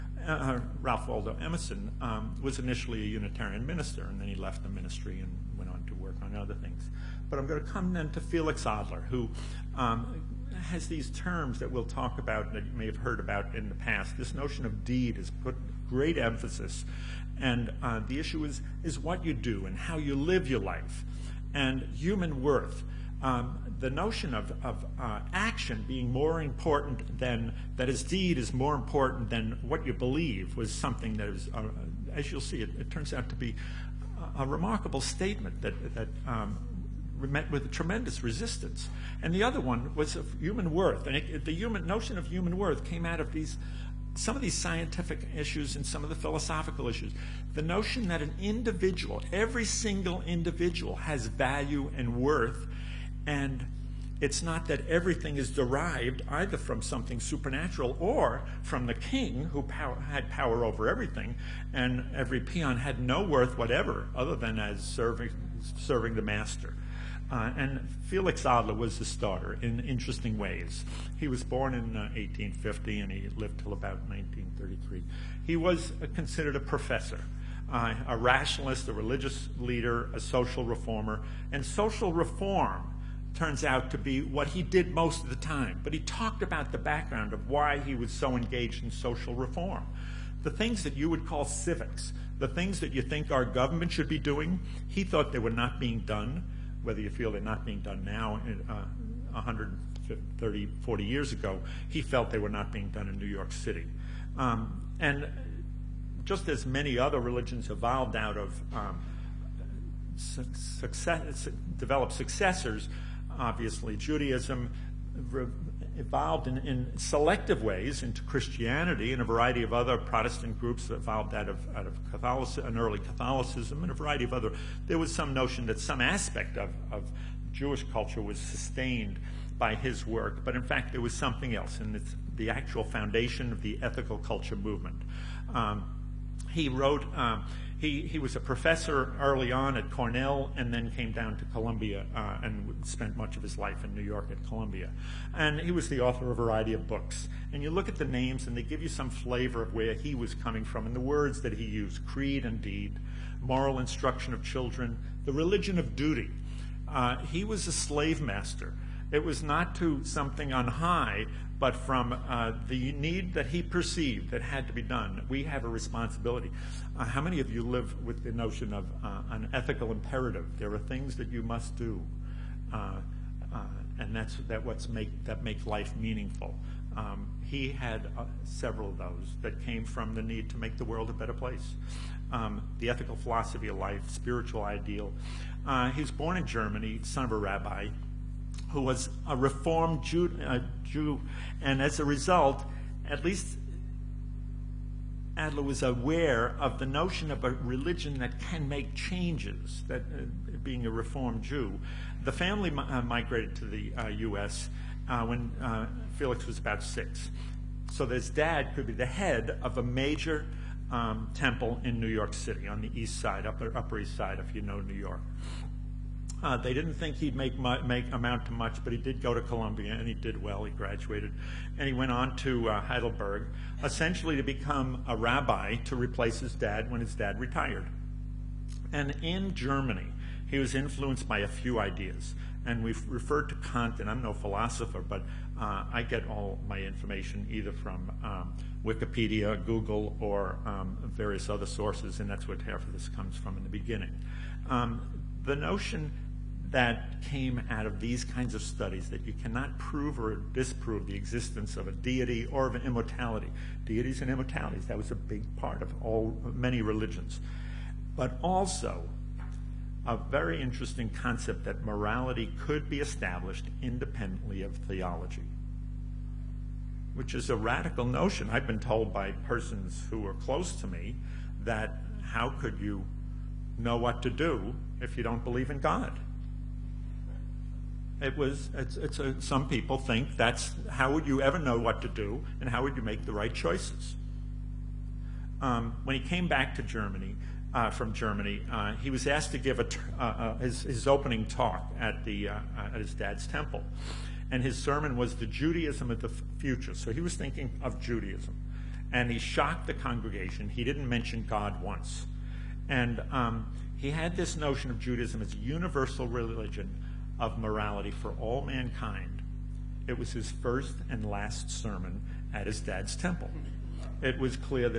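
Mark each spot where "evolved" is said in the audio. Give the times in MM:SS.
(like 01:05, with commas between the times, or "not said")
01:47, 01:55, 02:00.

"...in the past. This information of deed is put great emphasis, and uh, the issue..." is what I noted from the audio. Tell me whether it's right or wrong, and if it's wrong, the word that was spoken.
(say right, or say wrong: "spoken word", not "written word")
wrong: "notion", not "information".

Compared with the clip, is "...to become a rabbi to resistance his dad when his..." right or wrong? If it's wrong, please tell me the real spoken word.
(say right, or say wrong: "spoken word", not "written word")
wrong: "replace", not "resistance".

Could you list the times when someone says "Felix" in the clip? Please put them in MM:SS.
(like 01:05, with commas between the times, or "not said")
00:08, 01:08, 03:26.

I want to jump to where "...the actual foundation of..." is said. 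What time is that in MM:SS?
02:12.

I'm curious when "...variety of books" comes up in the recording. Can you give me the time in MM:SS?
02:26.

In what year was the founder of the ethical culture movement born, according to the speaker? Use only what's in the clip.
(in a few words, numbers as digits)
1850.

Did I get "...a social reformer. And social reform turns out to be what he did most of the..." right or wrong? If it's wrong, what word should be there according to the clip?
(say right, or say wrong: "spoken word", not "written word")
right.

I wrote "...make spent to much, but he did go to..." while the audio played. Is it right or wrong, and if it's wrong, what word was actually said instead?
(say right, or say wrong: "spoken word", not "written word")
wrong: "amount", not "spent".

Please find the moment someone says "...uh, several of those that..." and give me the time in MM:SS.
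02:58.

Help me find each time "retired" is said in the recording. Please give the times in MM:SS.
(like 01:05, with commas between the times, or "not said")
03:47.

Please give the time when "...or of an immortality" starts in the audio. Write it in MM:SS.
04:12.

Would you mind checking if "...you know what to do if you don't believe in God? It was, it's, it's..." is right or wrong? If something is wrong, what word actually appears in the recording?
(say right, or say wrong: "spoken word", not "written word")
right.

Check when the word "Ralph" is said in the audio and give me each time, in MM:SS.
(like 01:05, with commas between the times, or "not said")
00:00.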